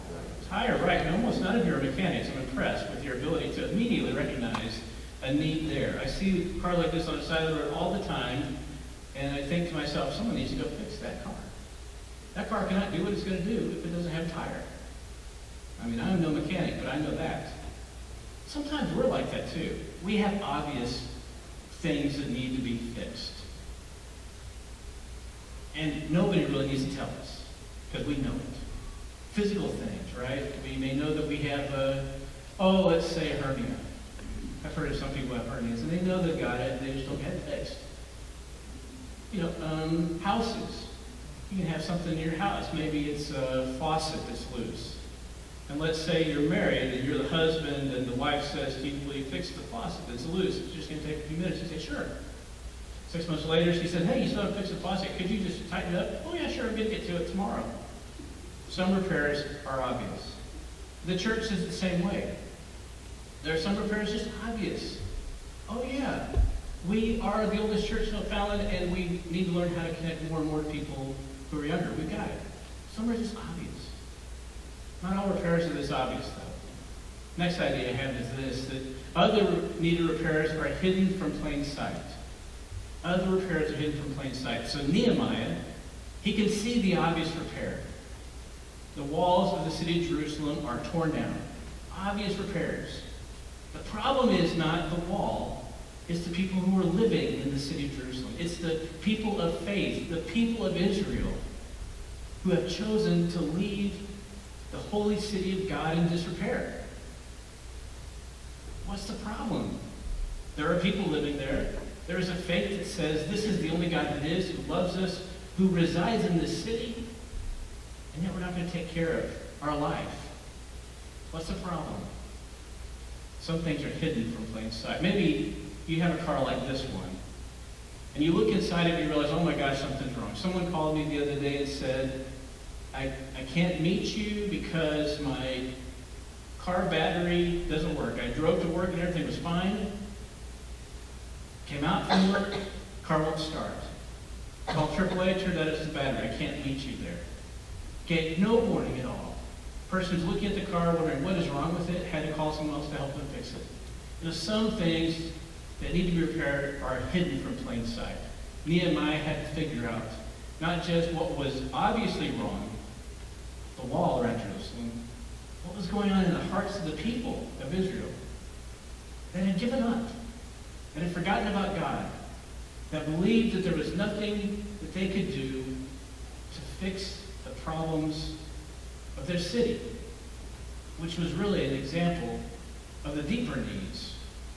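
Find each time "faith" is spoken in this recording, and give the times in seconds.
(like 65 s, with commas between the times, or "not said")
99 s, 112 s.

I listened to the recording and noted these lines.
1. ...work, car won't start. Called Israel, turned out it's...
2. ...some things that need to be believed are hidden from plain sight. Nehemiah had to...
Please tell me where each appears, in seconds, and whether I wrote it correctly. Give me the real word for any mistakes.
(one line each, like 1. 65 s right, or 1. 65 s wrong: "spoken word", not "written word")
1. 142 s wrong: "AAA", not "Israel"
2. 154 s wrong: "repaired", not "believed".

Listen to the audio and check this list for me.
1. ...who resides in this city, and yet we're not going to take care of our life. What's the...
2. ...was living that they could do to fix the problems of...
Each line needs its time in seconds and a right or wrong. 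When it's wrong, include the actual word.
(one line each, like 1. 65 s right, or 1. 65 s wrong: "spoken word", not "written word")
1. 115 s right
2. 173 s wrong: "nothing", not "living".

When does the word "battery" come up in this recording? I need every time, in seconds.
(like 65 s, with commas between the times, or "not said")
136 s, 145 s.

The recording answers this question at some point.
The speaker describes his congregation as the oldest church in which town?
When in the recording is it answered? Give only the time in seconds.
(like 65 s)
68 s.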